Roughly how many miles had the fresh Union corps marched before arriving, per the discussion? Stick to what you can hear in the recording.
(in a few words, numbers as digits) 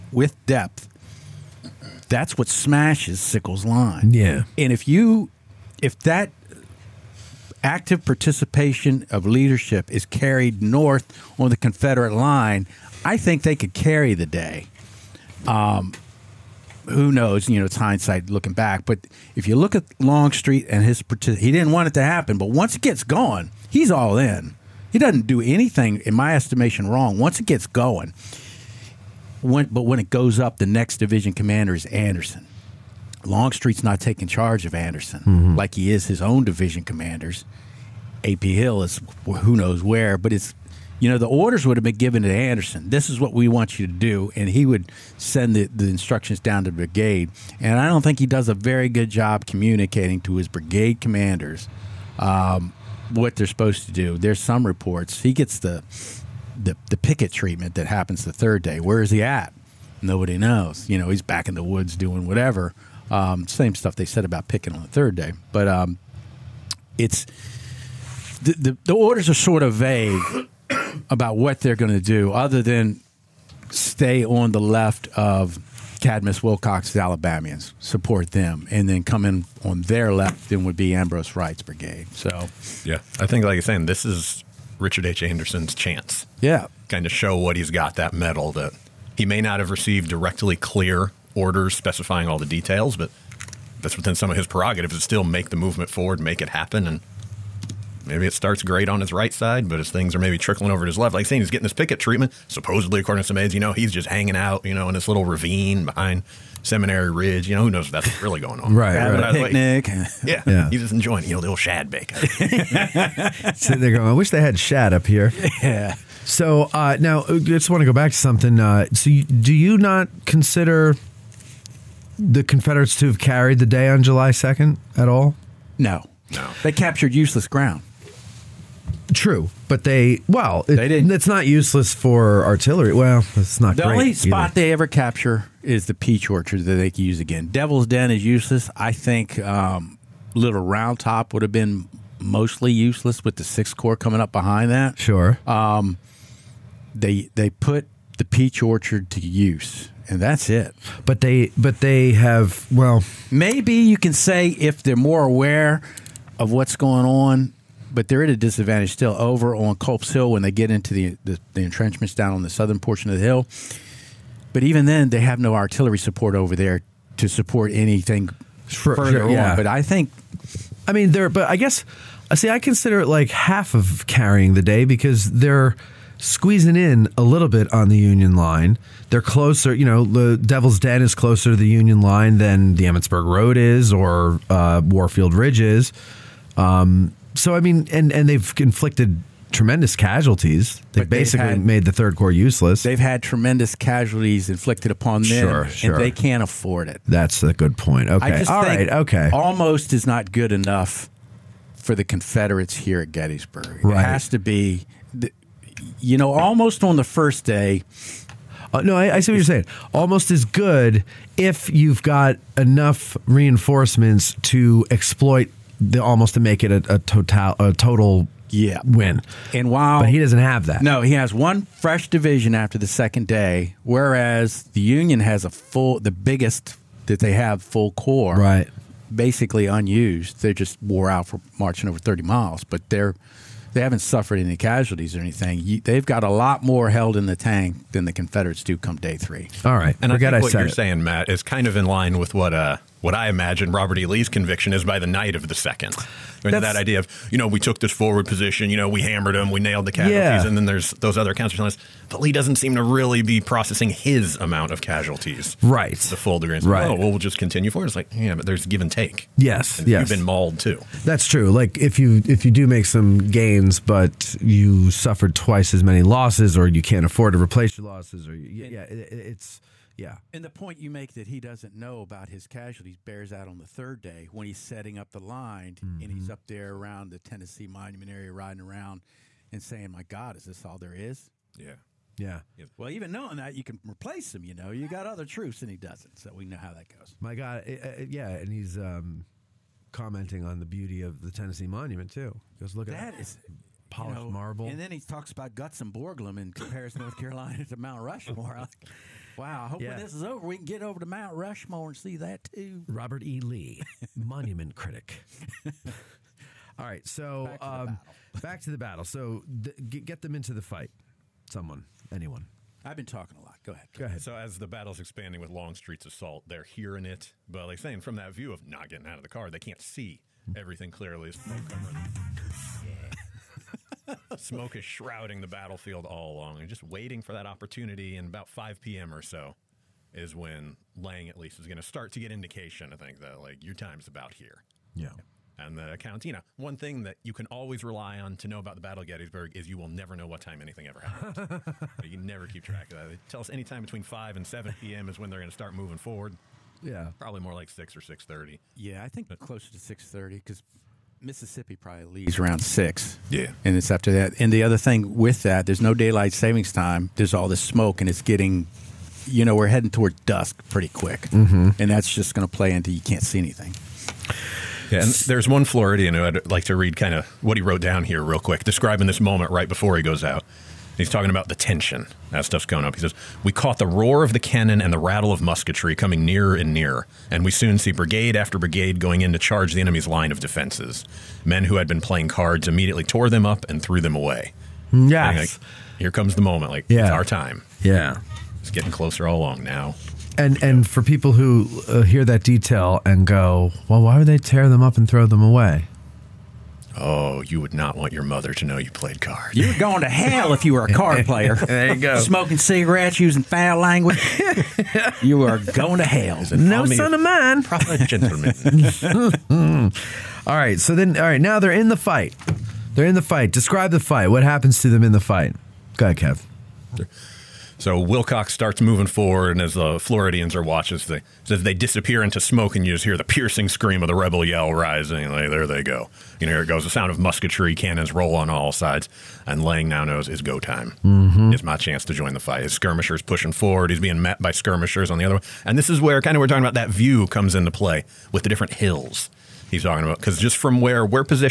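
Over 30.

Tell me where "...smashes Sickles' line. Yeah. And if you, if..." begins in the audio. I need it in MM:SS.
00:02.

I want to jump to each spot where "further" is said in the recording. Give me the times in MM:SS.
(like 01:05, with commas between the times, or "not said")
02:48.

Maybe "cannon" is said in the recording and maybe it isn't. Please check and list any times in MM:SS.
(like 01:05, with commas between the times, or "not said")
06:14, 07:07.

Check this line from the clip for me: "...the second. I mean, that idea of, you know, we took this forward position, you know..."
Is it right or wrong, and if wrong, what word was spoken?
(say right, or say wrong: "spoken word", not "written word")
right.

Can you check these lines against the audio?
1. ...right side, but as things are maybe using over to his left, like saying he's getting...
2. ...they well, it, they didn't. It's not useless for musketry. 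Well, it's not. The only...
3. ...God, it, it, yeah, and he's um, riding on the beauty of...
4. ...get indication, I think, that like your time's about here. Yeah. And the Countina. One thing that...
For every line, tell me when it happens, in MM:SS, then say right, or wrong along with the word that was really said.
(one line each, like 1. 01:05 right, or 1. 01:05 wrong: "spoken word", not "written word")
1. 01:39 wrong: "trickling", not "using"
2. 02:09 wrong: "artillery", not "musketry"
3. 04:47 wrong: "commenting", not "riding"
4. 05:32 right.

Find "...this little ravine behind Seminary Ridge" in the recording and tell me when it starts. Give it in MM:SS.
01:44.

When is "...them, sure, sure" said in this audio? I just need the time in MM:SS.
03:15.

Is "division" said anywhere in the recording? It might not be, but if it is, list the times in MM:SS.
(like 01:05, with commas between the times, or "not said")
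00:30, 00:36, 03:42.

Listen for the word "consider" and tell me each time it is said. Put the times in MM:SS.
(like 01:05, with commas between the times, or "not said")
02:00, 02:52.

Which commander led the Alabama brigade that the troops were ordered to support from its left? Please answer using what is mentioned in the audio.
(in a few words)
Cadmus Wilcox.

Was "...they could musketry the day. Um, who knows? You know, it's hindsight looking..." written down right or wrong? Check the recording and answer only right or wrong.
wrong.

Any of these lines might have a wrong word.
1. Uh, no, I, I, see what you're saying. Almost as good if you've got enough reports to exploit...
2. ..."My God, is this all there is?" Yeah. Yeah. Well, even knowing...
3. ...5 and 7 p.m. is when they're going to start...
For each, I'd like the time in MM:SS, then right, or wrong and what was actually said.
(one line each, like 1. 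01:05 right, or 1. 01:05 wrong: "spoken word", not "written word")
1. 03:28 wrong: "reinforcements", not "reports"
2. 04:39 right
3. 05:44 right.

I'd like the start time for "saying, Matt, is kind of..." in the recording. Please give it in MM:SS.
04:00.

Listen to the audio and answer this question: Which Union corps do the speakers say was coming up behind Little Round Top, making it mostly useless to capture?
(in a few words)
Six corps.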